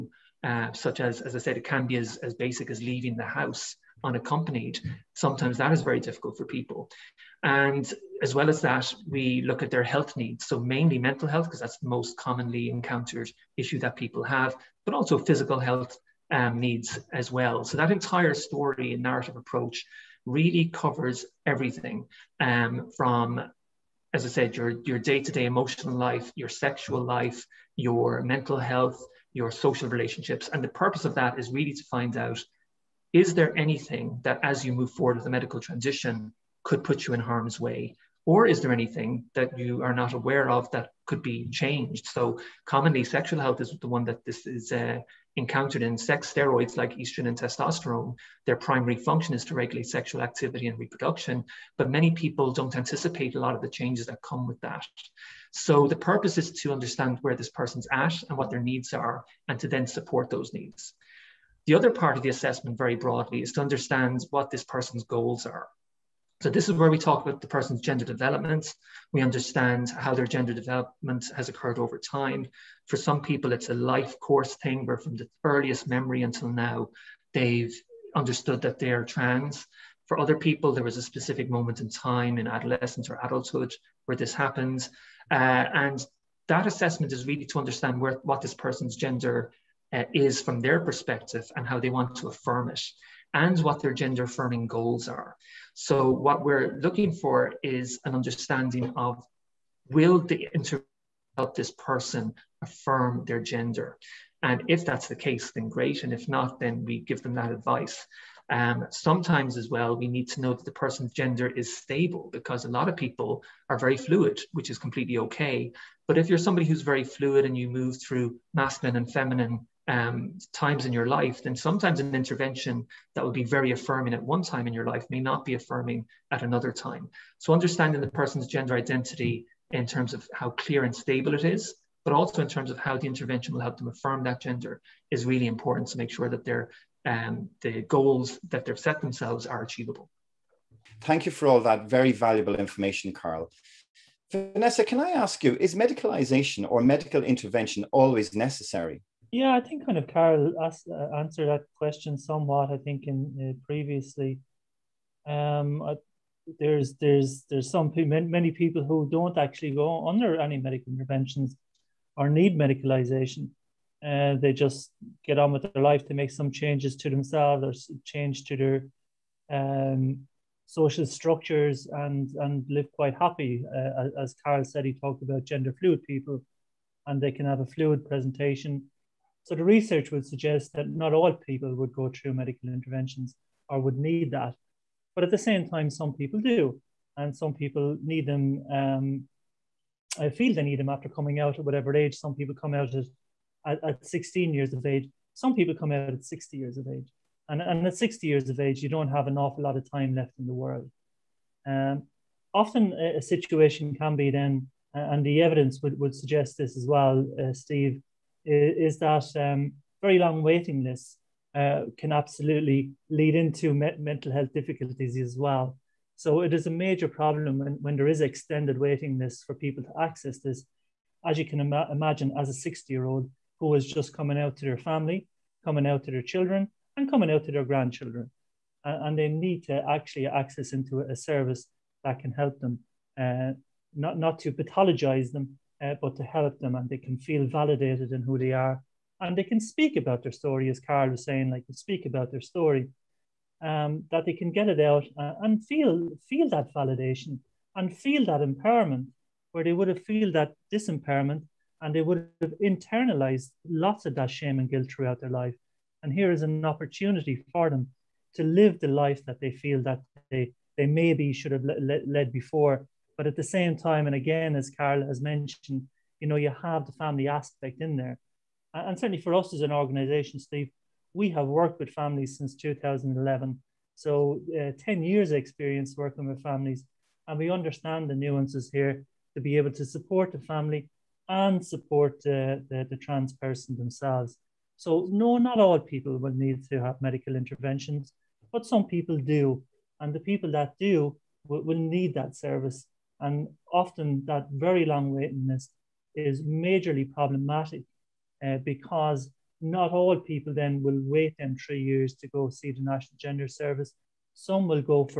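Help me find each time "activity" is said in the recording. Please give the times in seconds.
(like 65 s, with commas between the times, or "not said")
50 s.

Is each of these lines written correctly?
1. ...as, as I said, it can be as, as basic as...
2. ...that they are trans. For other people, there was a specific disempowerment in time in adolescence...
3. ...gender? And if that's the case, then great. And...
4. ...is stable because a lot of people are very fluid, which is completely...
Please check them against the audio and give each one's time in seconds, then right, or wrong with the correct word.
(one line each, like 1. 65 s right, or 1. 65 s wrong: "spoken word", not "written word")
1. 1 s right
2. 78 s wrong: "moment", not "disempowerment"
3. 103 s right
4. 111 s right.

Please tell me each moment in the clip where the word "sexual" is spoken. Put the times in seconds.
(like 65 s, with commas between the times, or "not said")
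26 s, 43 s, 49 s.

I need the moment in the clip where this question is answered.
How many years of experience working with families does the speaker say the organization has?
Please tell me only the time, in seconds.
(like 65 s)
274 s.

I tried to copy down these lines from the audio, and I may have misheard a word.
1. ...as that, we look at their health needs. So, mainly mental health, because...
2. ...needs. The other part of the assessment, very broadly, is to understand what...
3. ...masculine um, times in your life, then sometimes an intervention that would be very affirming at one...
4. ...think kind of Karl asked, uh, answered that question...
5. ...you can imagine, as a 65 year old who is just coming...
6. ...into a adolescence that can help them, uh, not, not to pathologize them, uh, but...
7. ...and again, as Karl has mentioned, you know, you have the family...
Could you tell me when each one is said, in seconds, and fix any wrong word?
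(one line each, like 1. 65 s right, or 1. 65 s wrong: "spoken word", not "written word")
1. 8 s right
2. 60 s right
3. 119 s wrong: "feminine", not "masculine"
4. 149 s right
5. 221 s wrong: "60", not "65"
6. 230 s wrong: "service", not "adolescence"
7. 264 s right.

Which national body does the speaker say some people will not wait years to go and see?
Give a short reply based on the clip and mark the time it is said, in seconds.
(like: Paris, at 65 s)
National Gender Service, at 302 s.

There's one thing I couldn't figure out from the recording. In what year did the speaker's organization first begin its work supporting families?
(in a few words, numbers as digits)
2011.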